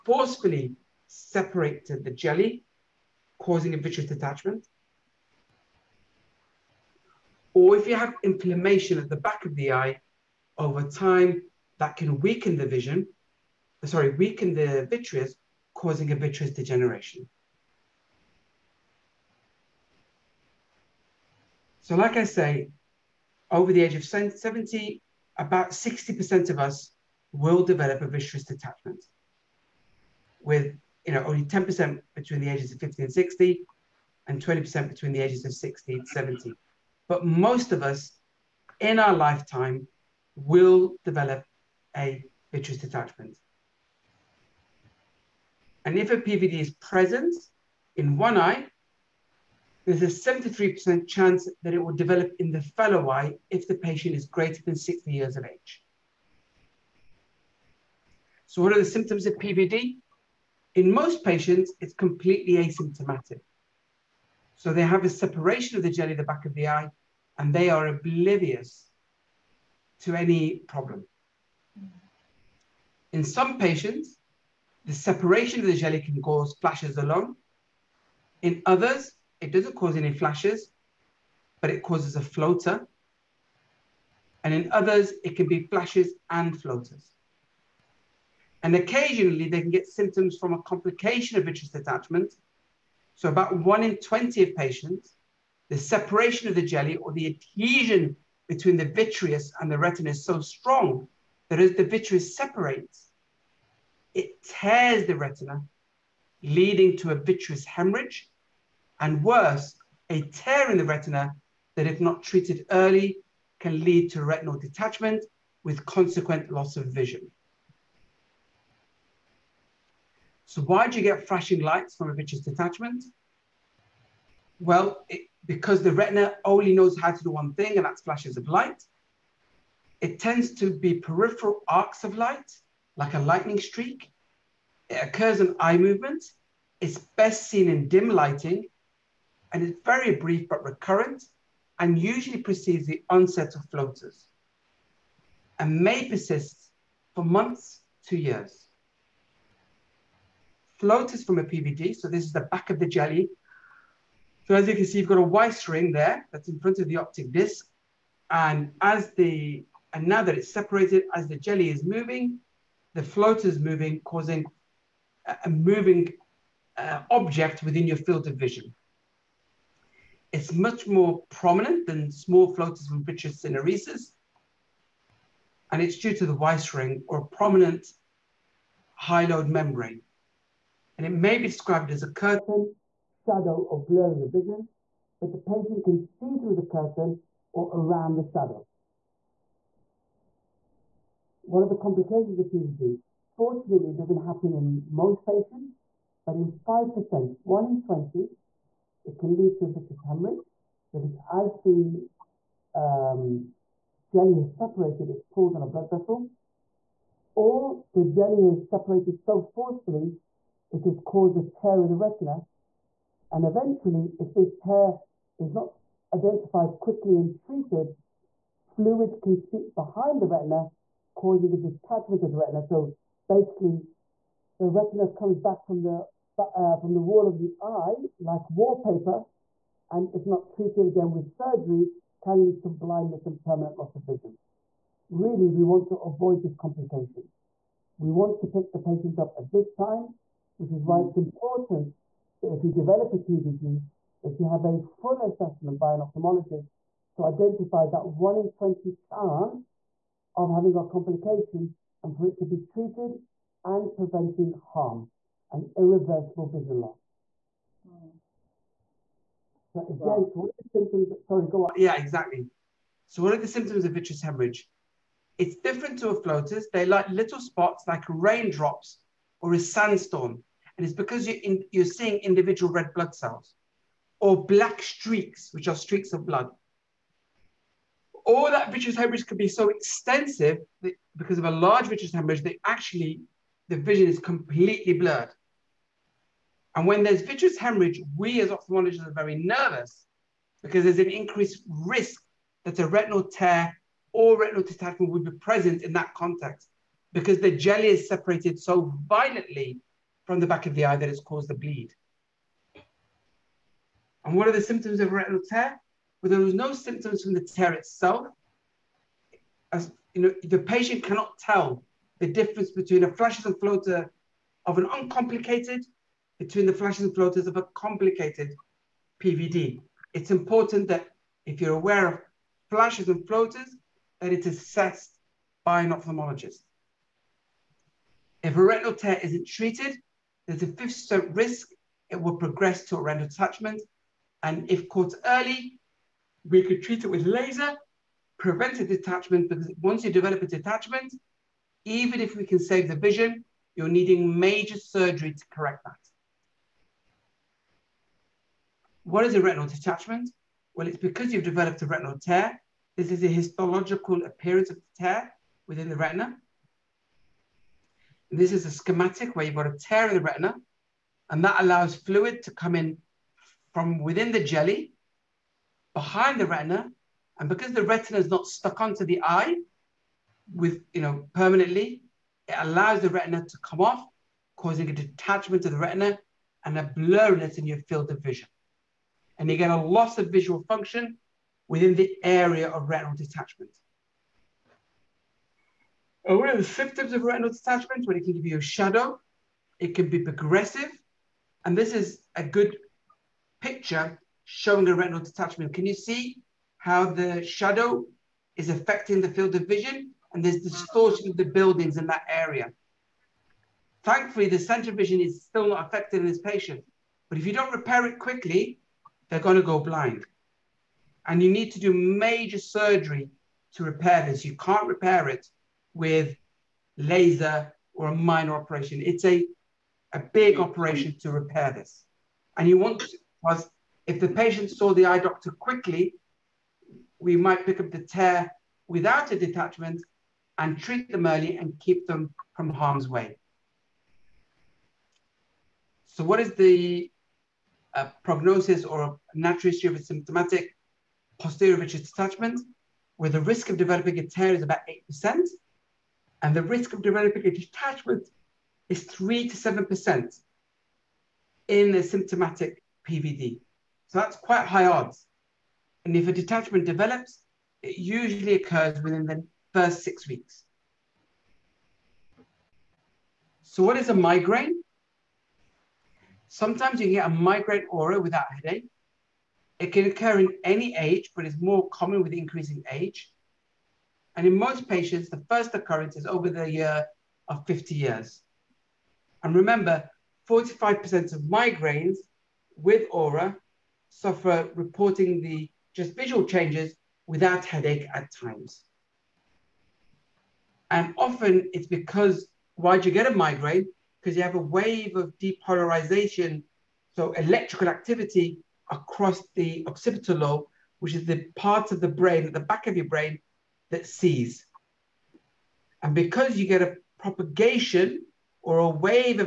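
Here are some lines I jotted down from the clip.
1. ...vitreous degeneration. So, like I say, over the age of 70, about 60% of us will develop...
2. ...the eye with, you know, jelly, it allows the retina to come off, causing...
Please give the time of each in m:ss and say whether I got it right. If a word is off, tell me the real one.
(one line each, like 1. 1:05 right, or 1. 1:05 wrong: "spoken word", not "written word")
1. 0:16 right
2. 6:09 wrong: "permanently", not "jelly".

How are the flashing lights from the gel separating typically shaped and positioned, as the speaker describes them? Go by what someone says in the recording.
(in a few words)
peripheral arcs.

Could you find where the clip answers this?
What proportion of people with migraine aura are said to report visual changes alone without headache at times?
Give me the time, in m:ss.
8:00.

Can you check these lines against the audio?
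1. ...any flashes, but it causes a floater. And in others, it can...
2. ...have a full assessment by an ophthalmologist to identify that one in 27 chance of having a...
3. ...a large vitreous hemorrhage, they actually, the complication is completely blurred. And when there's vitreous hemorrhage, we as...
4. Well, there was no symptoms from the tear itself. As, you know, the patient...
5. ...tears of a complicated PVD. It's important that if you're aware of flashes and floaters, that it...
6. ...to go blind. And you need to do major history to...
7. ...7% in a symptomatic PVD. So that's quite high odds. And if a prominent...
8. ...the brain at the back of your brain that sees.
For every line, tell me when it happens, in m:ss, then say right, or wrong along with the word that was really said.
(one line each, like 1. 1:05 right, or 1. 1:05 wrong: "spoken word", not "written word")
1. 1:19 right
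2. 4:04 wrong: "20", not "27"
3. 4:41 wrong: "vision", not "complication"
4. 5:06 right
5. 5:17 wrong: "floaters", not "tears"
6. 6:49 wrong: "surgery", not "history"
7. 7:29 wrong: "detachment", not "prominent"
8. 8:22 right.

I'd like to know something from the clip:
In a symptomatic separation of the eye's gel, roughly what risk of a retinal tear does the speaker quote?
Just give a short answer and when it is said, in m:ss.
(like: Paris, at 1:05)
8%, at 7:25.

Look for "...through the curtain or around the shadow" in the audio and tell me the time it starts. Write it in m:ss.
3:06.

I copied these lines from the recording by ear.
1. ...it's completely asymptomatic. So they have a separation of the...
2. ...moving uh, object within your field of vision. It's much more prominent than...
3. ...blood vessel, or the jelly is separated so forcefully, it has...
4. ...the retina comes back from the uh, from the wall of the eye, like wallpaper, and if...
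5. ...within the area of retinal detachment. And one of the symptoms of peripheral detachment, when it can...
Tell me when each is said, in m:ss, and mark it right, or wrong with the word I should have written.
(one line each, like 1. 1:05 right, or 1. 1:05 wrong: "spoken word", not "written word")
1. 1:01 right
2. 2:45 right
3. 3:25 right
4. 3:44 right
5. 6:21 wrong: "retinal", not "peripheral".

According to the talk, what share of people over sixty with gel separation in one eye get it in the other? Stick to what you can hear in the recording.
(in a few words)
73%.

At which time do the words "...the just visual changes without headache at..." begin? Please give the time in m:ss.
8:05.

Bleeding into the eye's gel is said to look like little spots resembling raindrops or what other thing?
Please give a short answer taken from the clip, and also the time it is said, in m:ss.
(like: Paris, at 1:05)
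a sandstorm, at 4:29.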